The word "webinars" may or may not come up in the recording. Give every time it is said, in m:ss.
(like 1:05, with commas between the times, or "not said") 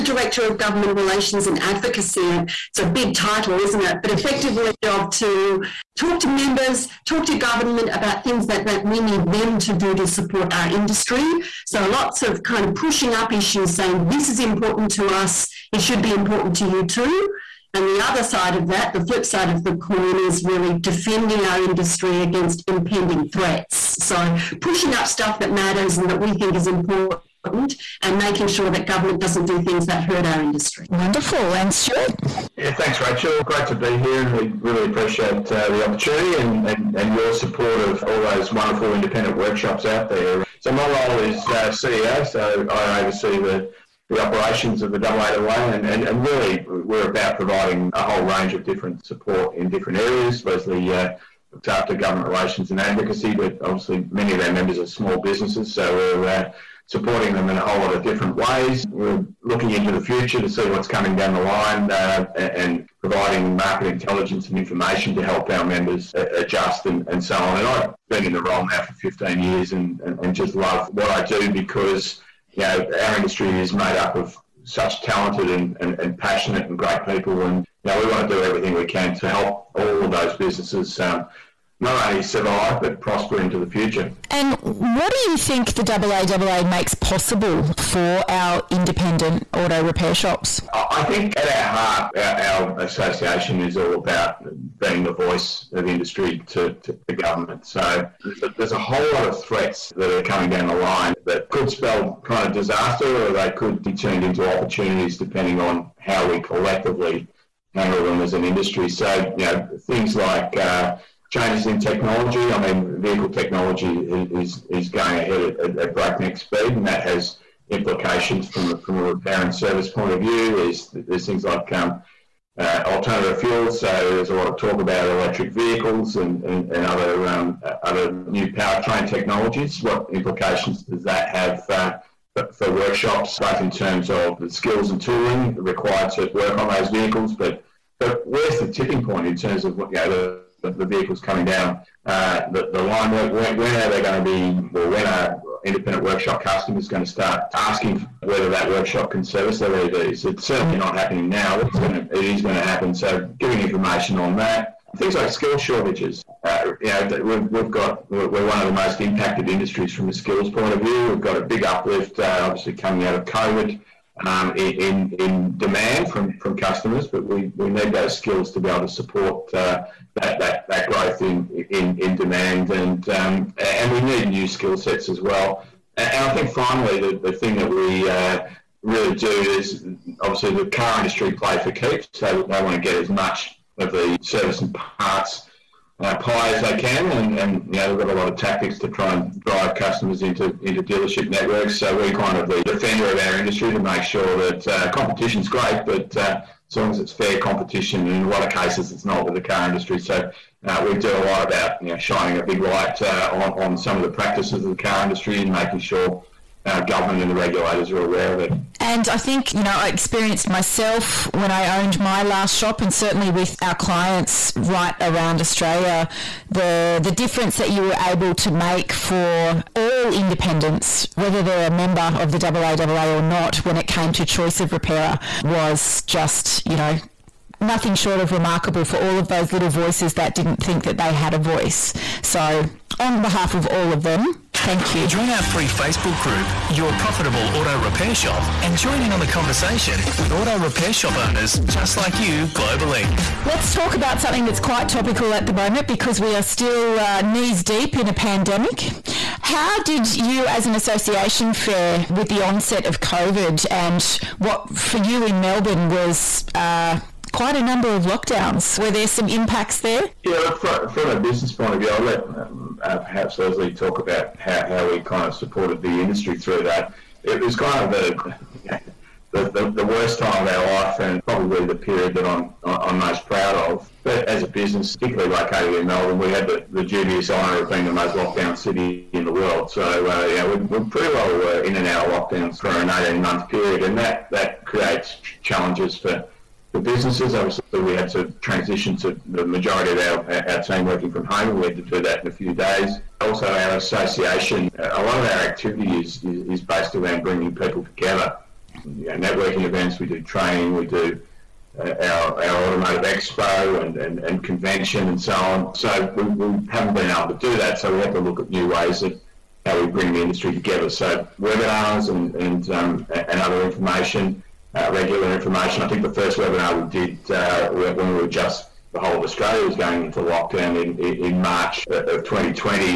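5:11, 5:16.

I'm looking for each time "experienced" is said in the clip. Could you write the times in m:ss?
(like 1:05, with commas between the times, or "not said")
3:29.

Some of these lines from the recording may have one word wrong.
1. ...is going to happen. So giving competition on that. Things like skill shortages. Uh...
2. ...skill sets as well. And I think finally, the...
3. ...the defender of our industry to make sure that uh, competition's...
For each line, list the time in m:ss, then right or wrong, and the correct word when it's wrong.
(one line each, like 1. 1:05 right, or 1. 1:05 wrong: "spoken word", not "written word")
1. 2:32 wrong: "information", not "competition"
2. 2:54 right
3. 3:12 right.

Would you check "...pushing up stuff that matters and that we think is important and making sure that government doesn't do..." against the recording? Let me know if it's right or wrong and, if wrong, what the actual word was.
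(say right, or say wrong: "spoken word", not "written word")
right.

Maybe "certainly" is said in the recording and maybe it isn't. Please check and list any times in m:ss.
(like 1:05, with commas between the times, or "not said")
2:30, 3:32.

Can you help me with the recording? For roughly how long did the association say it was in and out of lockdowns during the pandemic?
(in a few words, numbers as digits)
18 months.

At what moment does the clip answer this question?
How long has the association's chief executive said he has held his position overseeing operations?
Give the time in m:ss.
1:08.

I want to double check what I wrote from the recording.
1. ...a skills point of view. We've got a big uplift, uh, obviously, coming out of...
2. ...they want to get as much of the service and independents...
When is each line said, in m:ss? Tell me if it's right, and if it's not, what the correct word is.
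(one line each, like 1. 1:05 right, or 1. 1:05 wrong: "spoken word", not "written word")
1. 2:40 right
2. 3:02 wrong: "parts", not "independents".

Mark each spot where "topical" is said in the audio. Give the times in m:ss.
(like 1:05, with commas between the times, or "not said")
4:04.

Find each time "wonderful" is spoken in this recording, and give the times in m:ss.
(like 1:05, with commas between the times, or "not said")
0:30, 0:38.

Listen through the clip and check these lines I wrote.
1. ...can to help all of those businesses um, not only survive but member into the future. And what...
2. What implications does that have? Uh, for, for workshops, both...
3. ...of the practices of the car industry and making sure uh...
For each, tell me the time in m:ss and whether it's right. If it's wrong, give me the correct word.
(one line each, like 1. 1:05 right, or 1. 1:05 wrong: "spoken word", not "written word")
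1. 1:18 wrong: "prosper", not "member"
2. 2:09 right
3. 3:23 right.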